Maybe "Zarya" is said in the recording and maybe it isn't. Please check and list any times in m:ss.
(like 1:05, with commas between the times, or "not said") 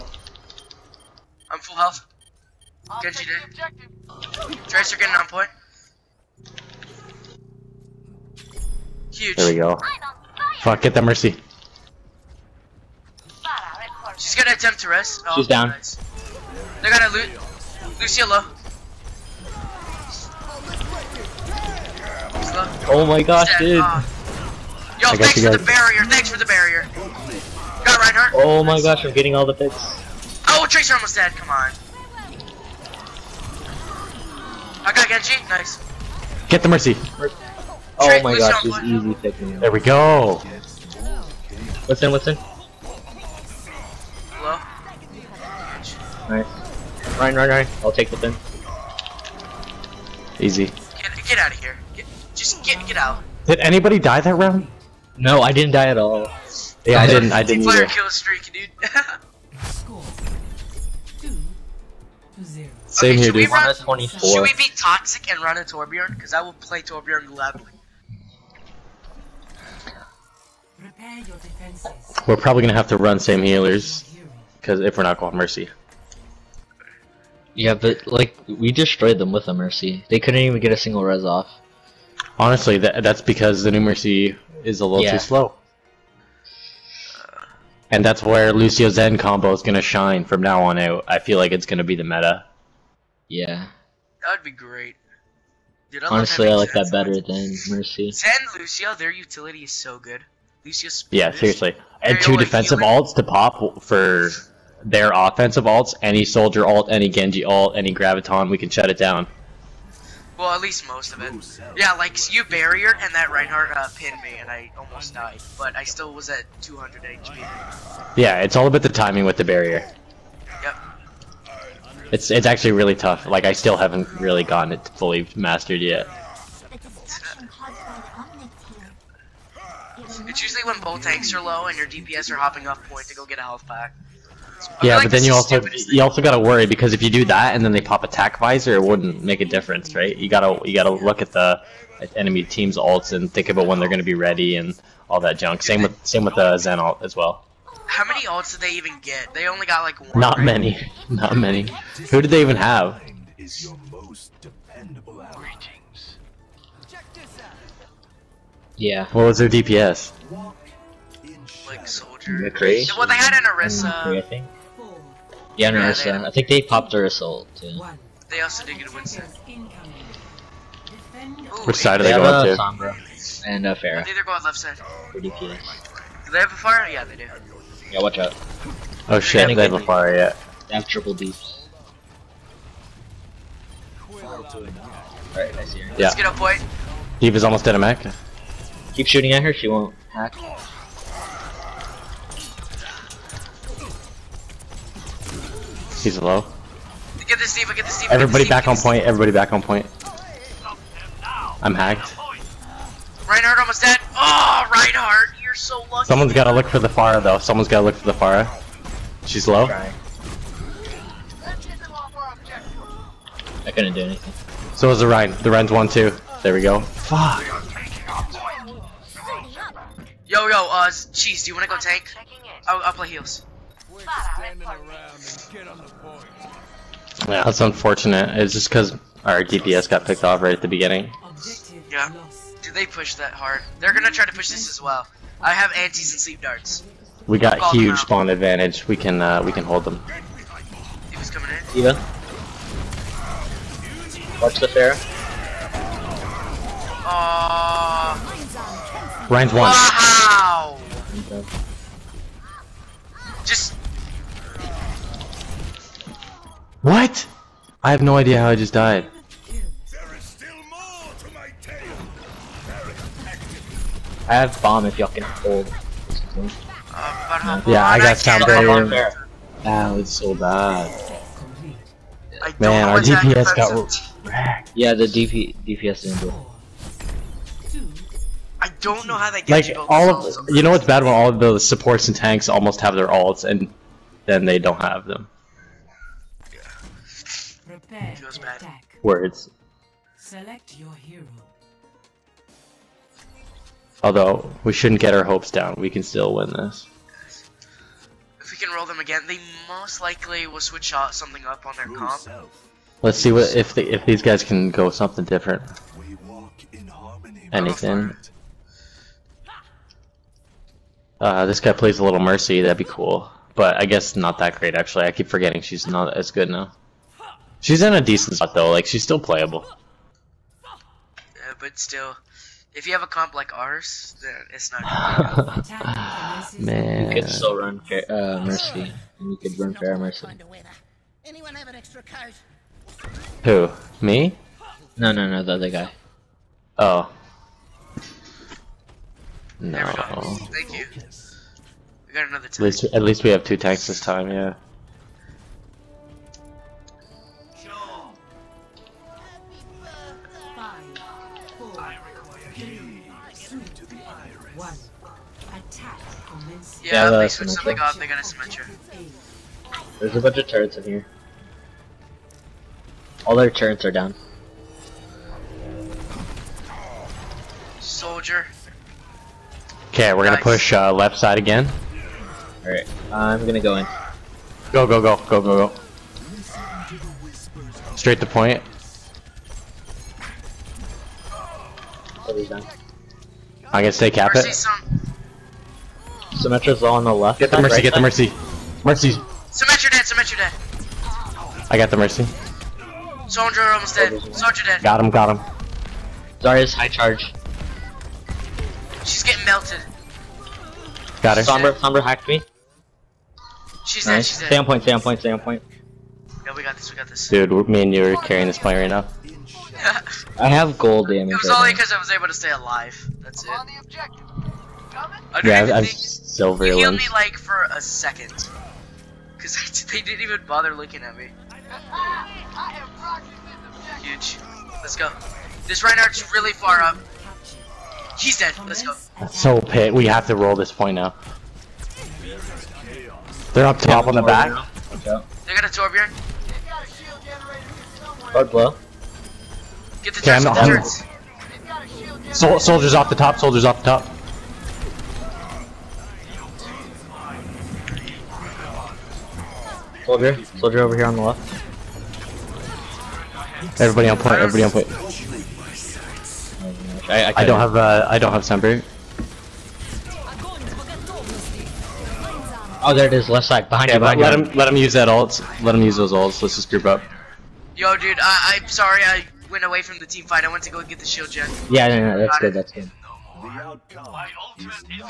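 6:36.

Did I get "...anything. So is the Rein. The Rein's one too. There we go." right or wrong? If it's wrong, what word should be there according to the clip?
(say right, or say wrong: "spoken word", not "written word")
right.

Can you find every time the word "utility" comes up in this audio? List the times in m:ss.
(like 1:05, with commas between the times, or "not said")
1:39.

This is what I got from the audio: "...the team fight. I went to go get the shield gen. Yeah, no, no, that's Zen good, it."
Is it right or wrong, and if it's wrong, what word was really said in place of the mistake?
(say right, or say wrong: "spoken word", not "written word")
wrong: "Got", not "Zen".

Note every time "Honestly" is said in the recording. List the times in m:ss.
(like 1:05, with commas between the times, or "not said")
1:22, 1:36.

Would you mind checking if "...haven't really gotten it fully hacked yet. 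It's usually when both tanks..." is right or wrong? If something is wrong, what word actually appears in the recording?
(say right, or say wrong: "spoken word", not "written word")
wrong: "mastered", not "hacked".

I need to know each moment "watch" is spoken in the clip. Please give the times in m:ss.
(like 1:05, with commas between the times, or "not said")
2:58, 4:04.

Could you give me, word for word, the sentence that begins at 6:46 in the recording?
Yeah, we got this, we got this.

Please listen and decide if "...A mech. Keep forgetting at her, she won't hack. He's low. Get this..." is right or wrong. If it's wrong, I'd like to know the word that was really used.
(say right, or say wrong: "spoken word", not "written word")
wrong: "shooting", not "forgetting".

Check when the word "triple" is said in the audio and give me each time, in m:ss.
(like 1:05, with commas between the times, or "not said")
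3:00.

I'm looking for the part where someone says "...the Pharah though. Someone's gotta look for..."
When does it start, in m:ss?
3:26.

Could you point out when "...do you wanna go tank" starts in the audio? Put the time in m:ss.
3:41.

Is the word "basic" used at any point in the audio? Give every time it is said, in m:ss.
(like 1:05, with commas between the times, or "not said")
not said.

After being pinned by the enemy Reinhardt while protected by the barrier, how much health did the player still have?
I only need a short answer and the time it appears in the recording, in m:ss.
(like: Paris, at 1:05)
200 HP, at 1:56.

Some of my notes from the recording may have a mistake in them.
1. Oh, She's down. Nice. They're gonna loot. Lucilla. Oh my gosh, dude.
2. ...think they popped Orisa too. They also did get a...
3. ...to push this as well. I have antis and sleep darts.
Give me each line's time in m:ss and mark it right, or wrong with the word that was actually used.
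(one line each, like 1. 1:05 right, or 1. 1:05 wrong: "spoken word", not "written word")
1. 0:15 right
2. 2:46 right
3. 3:54 right.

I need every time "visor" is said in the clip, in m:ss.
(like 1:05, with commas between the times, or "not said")
2:18.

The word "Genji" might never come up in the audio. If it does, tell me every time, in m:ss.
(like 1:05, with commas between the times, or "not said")
0:03, 0:35, 1:47.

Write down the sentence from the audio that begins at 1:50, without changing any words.
Well, at least most of it.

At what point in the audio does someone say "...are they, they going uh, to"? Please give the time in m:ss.
2:51.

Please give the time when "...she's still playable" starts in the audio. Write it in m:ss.
5:18.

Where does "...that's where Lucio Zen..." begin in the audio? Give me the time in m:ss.
1:28.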